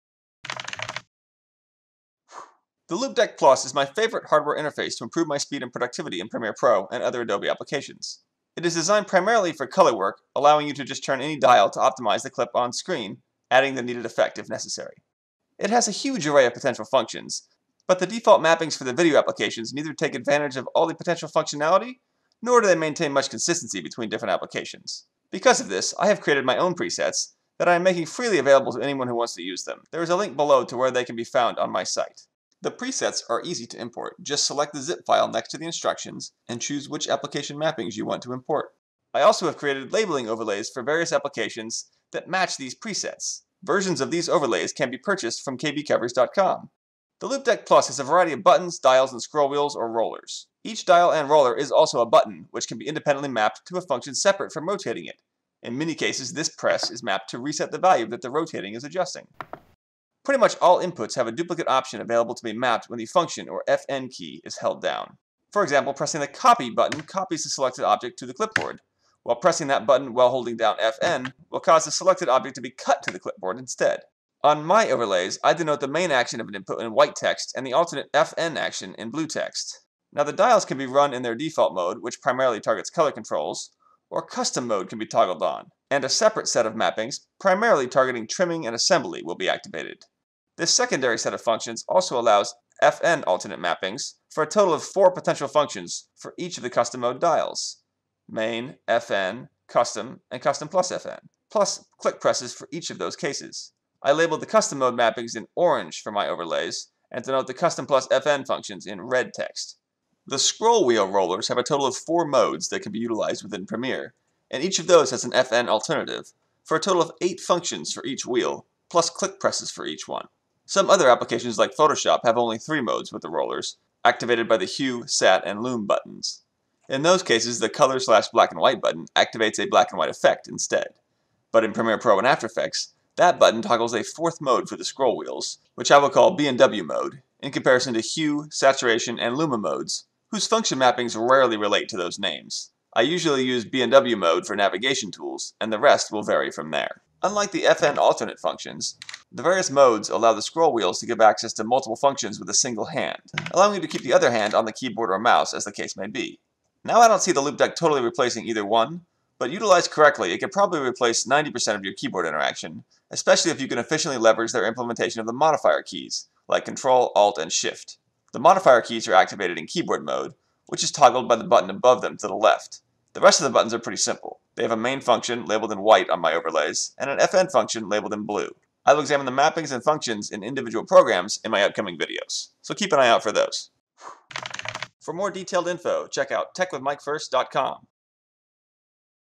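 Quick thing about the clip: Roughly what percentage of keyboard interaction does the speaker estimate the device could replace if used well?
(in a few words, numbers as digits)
90%.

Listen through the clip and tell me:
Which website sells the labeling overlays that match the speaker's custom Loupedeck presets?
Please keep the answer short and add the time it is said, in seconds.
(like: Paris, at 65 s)
kbcovers.com, at 45 s.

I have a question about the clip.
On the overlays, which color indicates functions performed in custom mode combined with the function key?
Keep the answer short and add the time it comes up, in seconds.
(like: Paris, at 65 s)
red, at 109 s.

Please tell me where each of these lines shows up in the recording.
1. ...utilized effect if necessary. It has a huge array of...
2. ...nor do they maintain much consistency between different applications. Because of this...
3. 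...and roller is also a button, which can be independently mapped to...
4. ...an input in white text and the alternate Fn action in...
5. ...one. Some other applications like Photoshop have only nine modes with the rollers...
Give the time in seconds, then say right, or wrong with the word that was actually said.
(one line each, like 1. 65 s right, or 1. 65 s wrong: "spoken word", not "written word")
1. 13 s wrong: "needed", not "utilized"
2. 22 s right
3. 51 s right
4. 76 s right
5. 120 s wrong: "three", not "nine".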